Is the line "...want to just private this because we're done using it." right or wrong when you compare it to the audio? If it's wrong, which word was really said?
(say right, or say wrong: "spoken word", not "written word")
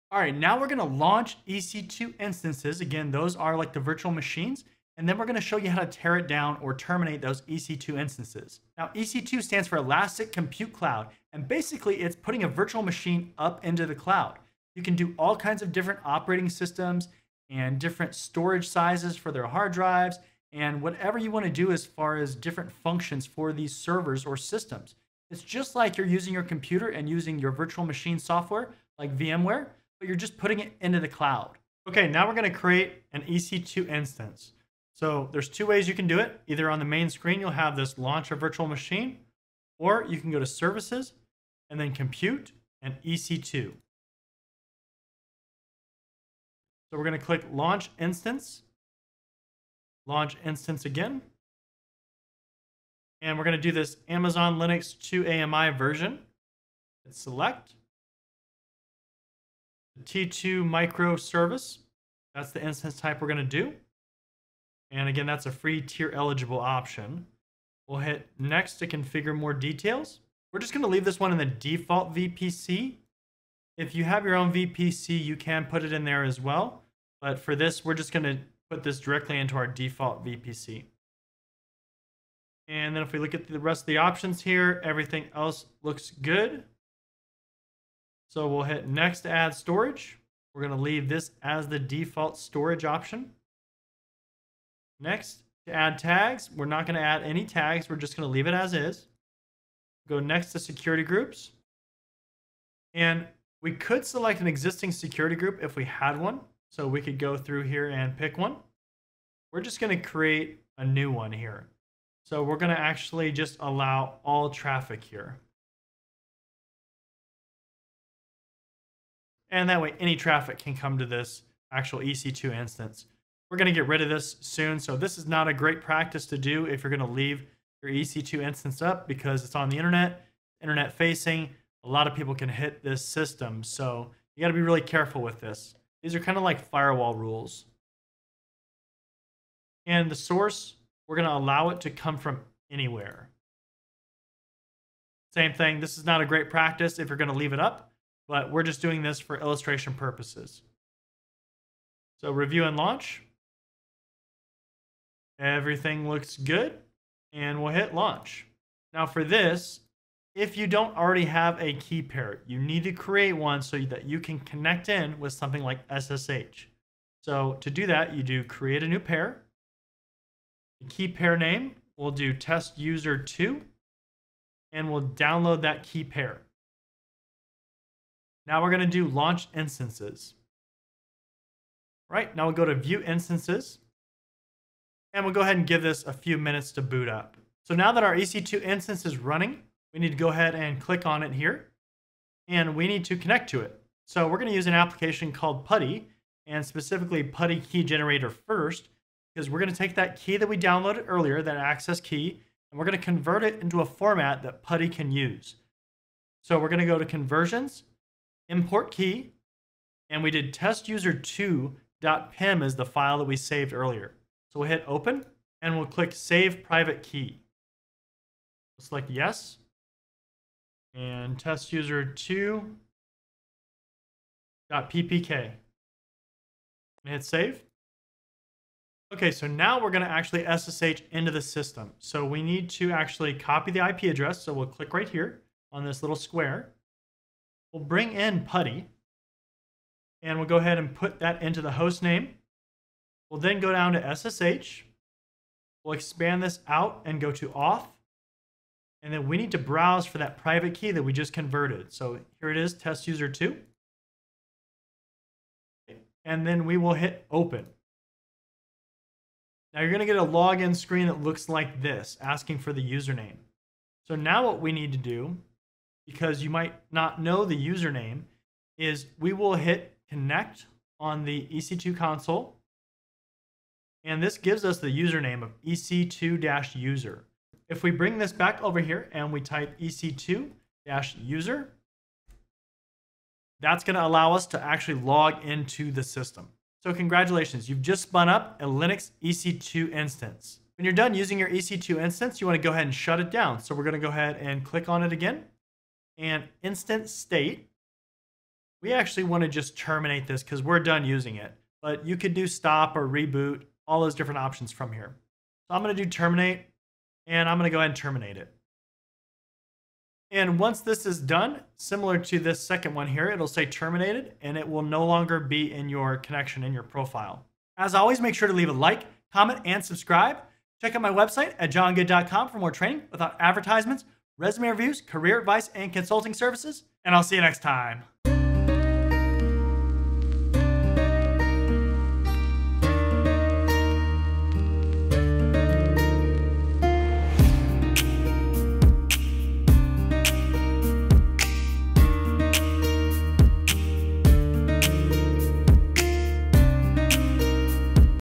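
wrong: "terminate", not "private".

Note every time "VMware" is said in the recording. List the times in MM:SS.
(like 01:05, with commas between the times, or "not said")
00:29.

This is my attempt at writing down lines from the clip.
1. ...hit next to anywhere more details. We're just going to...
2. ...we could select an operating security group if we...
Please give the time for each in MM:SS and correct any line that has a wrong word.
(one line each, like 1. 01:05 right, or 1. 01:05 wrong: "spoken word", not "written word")
1. 01:07 wrong: "configure", not "anywhere"
2. 01:43 wrong: "existing", not "operating".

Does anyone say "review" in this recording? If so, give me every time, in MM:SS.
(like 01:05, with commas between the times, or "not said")
02:32, 05:24.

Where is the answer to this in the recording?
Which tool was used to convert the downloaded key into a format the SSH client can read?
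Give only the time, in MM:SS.
03:17.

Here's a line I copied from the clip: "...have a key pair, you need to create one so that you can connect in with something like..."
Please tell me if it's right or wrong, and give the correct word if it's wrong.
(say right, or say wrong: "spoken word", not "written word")
right.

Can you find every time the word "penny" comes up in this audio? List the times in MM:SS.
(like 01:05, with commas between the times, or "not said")
not said.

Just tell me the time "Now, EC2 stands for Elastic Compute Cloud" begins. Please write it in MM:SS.
00:08.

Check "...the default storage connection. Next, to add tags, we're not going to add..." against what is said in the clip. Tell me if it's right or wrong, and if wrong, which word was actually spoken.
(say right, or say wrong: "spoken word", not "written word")
wrong: "option", not "connection".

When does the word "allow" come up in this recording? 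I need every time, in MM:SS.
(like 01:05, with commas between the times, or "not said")
01:53, 02:21, 04:44.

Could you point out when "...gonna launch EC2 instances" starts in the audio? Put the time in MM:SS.
00:00.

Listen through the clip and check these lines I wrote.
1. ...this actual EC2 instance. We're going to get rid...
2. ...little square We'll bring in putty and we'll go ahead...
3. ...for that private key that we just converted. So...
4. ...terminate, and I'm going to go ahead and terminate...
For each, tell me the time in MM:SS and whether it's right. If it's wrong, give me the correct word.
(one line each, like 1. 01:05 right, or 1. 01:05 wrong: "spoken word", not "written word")
1. 02:01 right
2. 03:56 right
3. 04:10 right
4. 05:06 right.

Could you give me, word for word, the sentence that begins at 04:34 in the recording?
And this gives us the username of EC2-user.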